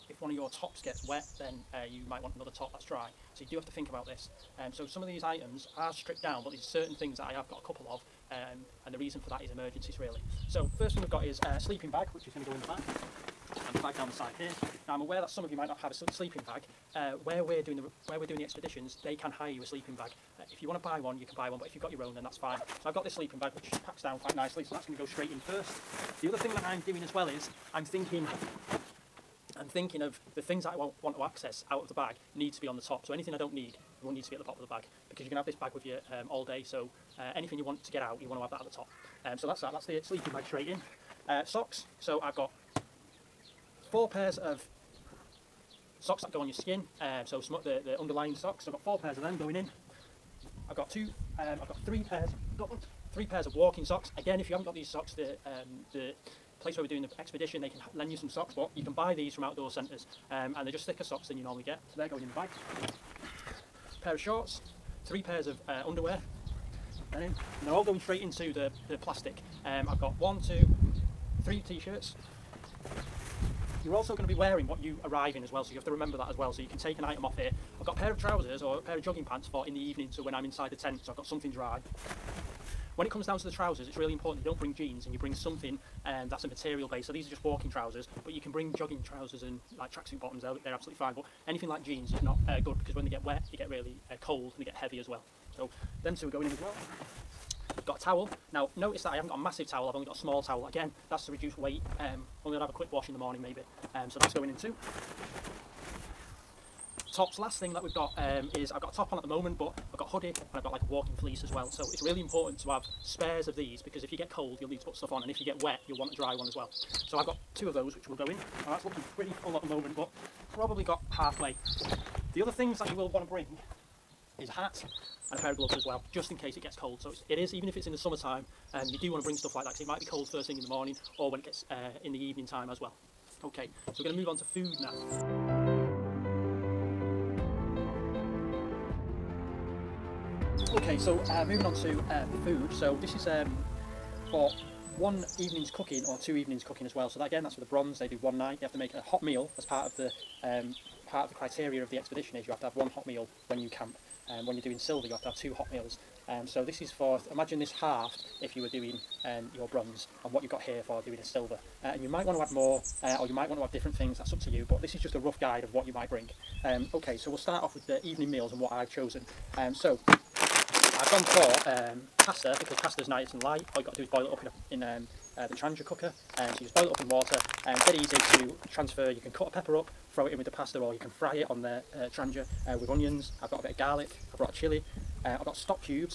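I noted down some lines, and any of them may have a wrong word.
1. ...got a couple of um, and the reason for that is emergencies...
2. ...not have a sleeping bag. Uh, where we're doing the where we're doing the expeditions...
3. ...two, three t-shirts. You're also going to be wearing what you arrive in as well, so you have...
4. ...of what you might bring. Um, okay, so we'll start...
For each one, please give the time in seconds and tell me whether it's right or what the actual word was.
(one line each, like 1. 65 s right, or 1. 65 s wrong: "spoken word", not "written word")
1. 7 s right
2. 15 s right
3. 70 s right
4. 165 s right.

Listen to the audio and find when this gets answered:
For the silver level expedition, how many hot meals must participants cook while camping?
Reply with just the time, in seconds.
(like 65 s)
155 s.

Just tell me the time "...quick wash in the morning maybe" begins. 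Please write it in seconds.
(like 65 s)
102 s.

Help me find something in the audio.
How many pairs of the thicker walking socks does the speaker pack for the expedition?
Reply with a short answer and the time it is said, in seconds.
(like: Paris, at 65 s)
3, at 53 s.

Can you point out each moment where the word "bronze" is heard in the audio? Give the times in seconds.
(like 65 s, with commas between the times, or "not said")
147 s, 159 s.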